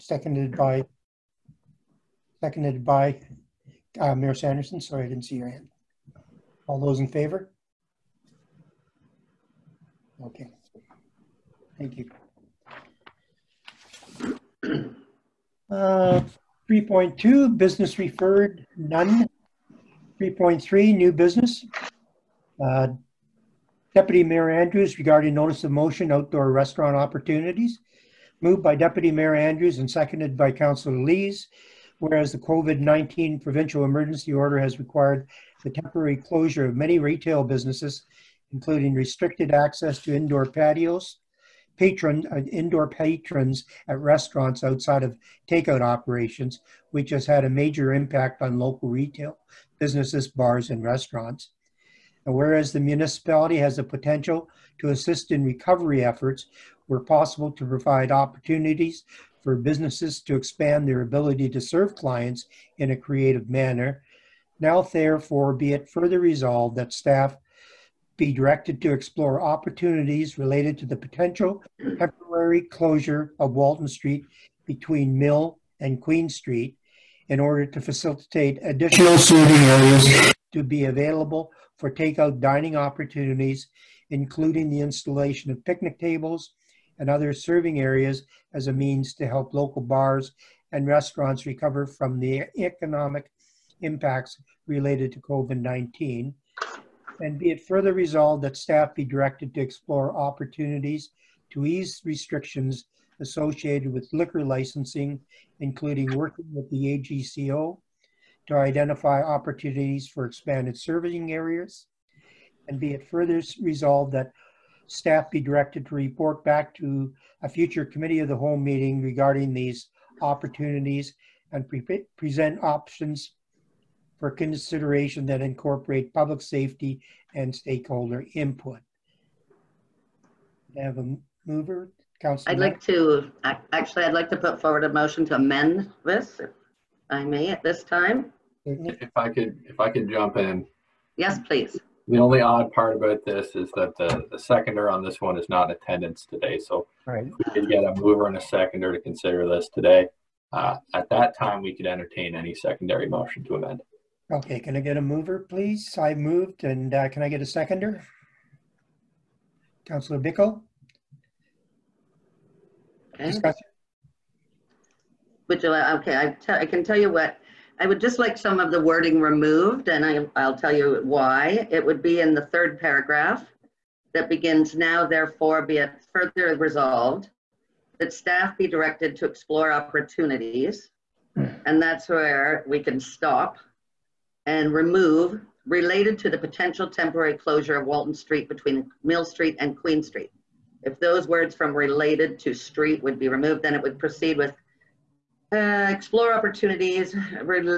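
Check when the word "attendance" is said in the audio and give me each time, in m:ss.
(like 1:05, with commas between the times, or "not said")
2:25.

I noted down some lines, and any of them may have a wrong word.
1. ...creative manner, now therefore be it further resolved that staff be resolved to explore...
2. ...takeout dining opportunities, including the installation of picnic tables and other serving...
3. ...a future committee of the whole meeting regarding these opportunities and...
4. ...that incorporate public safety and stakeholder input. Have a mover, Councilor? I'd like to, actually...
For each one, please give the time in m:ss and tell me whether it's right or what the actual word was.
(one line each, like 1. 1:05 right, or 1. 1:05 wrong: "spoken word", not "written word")
1. 1:02 wrong: "directed", not "resolved"
2. 1:21 right
3. 1:57 right
4. 2:05 right.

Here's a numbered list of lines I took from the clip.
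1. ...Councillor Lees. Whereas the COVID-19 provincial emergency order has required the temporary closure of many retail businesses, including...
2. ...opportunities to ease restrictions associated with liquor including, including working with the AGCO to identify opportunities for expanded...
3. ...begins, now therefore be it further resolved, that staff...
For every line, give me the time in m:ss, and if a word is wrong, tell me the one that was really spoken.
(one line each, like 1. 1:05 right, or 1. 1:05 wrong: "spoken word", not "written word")
1. 0:30 right
2. 1:40 wrong: "licensing", not "including"
3. 2:54 right.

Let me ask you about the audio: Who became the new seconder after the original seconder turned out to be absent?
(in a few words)
Councillor Bickle.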